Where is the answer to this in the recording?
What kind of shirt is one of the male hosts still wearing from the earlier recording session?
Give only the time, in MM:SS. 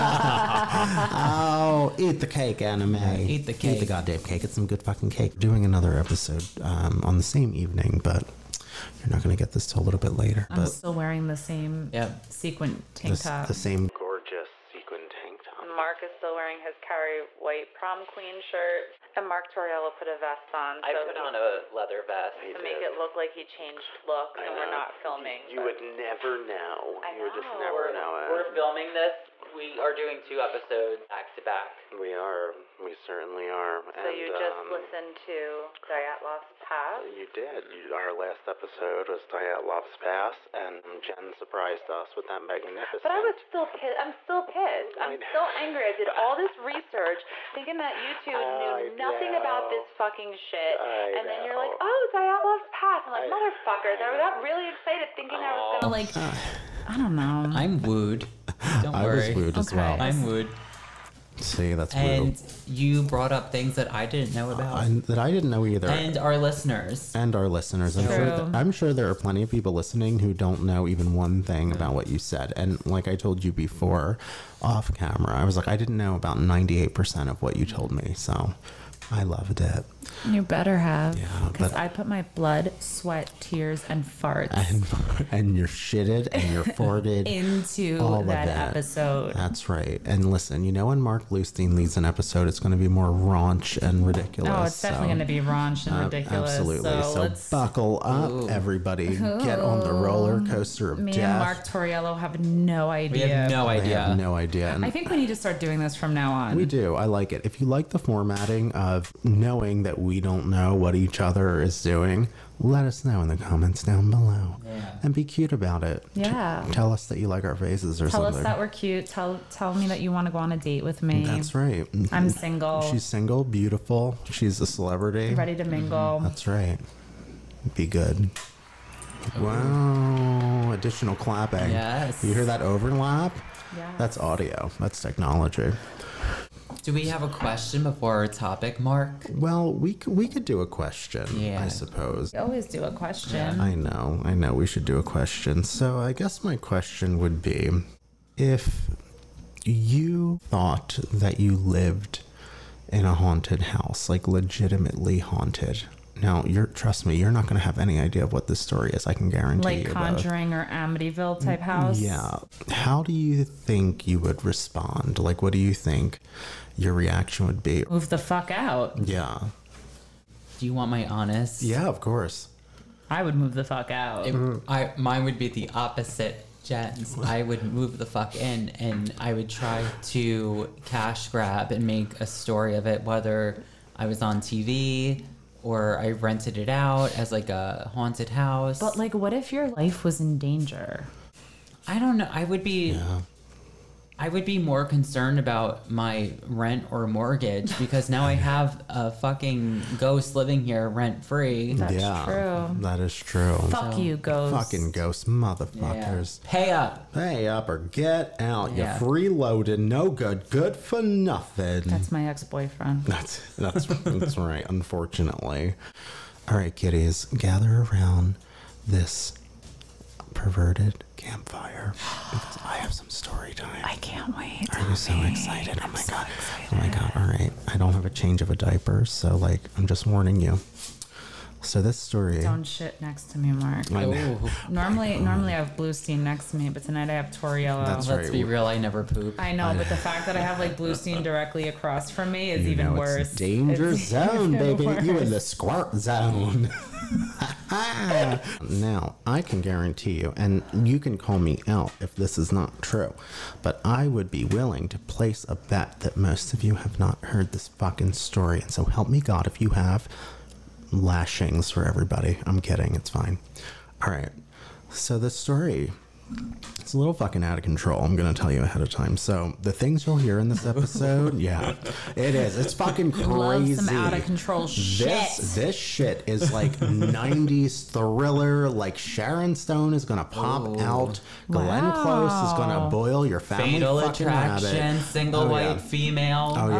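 00:16.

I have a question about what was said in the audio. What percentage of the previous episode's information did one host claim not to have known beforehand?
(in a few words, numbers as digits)
98%.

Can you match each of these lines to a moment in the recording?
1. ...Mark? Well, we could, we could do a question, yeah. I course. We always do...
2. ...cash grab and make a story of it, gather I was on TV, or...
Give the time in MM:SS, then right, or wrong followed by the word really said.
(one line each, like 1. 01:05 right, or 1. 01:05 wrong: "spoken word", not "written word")
1. 02:18 wrong: "suppose", not "course"
2. 03:00 wrong: "whether", not "gather".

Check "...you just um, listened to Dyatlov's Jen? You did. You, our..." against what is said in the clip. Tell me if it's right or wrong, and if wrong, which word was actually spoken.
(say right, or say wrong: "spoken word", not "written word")
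wrong: "Pass", not "Jen".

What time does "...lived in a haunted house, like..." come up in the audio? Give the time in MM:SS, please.
02:31.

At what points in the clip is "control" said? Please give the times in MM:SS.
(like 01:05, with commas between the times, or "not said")
04:27, 04:34.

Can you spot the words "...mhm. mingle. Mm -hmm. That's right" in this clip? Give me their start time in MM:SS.
02:05.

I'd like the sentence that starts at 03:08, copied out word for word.
But like, what if your life was in danger?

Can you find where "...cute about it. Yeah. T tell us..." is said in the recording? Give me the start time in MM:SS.
01:55.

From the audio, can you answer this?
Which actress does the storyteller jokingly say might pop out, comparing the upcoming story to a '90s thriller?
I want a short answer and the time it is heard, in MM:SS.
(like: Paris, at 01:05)
Sharon Stone, at 04:38.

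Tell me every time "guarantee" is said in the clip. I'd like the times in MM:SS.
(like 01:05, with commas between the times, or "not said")
02:39, 04:09.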